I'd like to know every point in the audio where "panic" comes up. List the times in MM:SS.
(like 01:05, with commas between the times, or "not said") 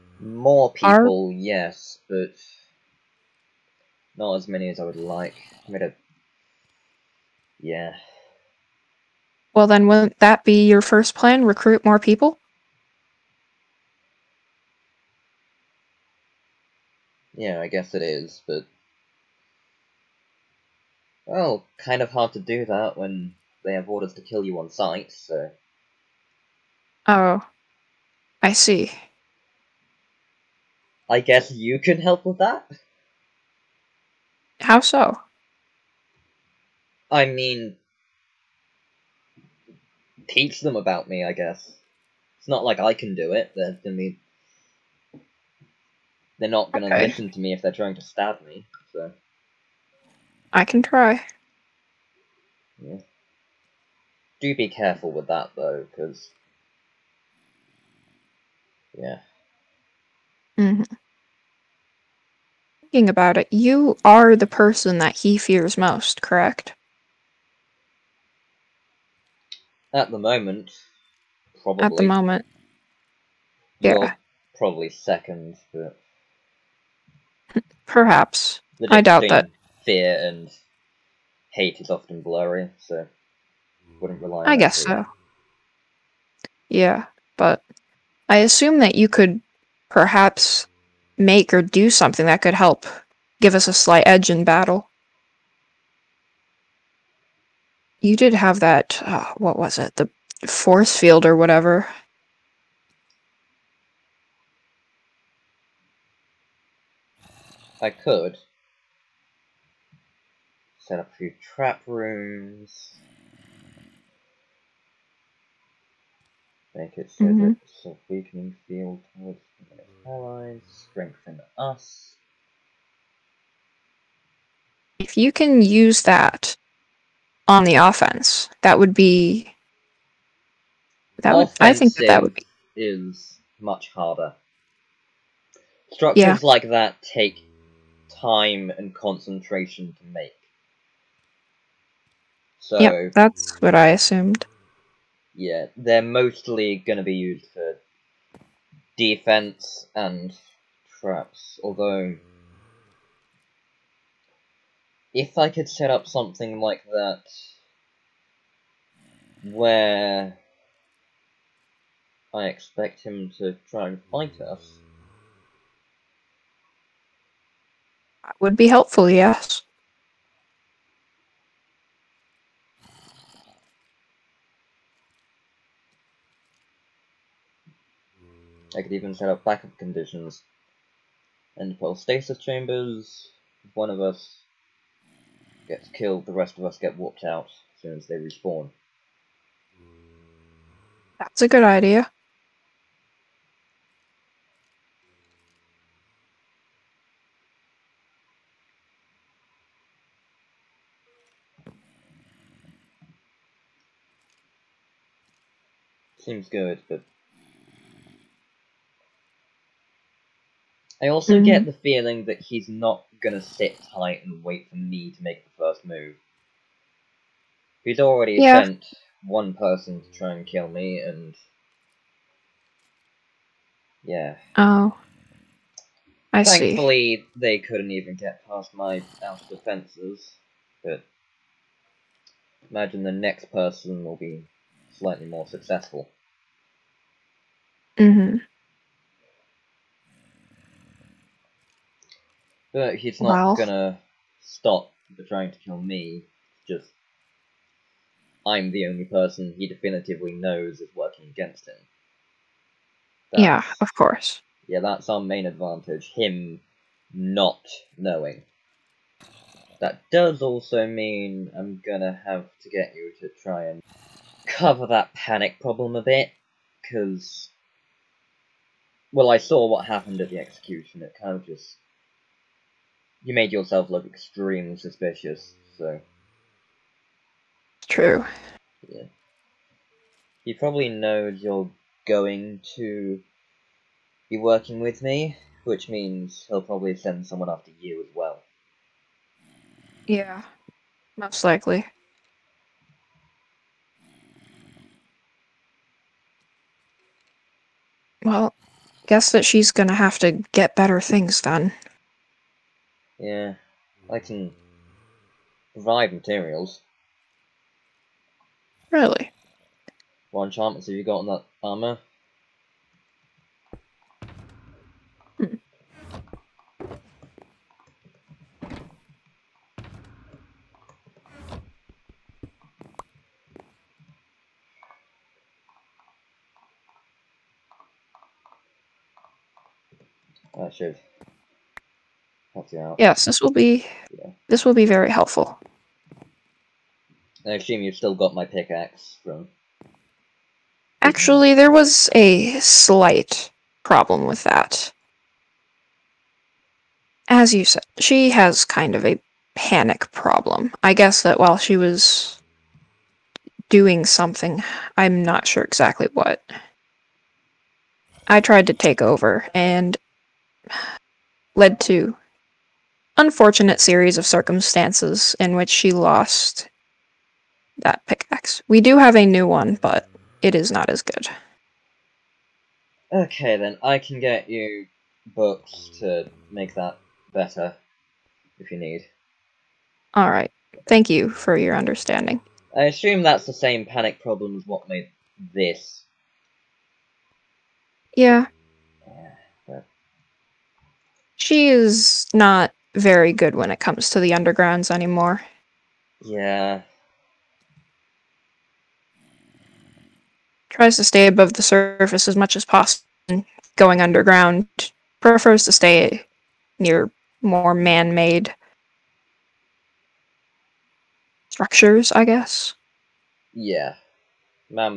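04:25, 05:49, 06:23.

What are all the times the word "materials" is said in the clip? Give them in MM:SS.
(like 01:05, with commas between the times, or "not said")
05:06.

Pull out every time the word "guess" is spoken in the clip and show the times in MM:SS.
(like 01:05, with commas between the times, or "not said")
00:17, 00:31, 00:41, 01:24, 04:59, 05:50, 06:52.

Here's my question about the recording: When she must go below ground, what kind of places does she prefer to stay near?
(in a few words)
man made structures.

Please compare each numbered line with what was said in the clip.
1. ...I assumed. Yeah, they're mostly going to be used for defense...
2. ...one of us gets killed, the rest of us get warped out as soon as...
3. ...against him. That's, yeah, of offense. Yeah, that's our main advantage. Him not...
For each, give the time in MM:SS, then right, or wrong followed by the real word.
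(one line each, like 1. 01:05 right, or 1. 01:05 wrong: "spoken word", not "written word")
1. 02:23 right
2. 03:03 right
3. 04:11 wrong: "course", not "offense".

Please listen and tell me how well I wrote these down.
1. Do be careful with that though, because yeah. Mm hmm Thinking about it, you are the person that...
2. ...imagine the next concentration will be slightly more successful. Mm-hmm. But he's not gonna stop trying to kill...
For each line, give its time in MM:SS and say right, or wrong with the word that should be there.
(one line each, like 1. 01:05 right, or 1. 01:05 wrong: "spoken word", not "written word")
1. 00:54 right
2. 03:52 wrong: "person", not "concentration".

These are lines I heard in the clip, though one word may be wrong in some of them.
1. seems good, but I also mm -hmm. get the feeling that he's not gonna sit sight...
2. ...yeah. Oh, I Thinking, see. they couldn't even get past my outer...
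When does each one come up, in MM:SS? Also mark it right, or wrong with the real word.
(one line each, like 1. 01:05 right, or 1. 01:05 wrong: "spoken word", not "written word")
1. 03:26 wrong: "tight", not "sight"
2. 03:44 wrong: "Thankfully", not "Thinking".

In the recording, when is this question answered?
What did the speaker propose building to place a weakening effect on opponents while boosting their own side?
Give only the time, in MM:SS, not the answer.
01:51.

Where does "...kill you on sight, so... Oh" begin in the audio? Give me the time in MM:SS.
00:24.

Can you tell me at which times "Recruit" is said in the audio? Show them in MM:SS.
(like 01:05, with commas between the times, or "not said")
00:11.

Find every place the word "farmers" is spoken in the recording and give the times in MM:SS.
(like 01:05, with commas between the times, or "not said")
not said.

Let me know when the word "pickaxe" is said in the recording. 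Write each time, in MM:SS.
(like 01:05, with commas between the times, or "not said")
05:38, 06:08.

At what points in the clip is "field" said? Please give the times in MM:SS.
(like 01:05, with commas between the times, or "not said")
01:40, 01:58.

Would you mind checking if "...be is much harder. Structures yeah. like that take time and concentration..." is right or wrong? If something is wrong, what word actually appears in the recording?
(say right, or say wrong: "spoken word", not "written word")
right.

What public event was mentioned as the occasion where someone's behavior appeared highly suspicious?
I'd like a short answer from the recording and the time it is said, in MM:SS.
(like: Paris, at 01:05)
the execution, at 04:30.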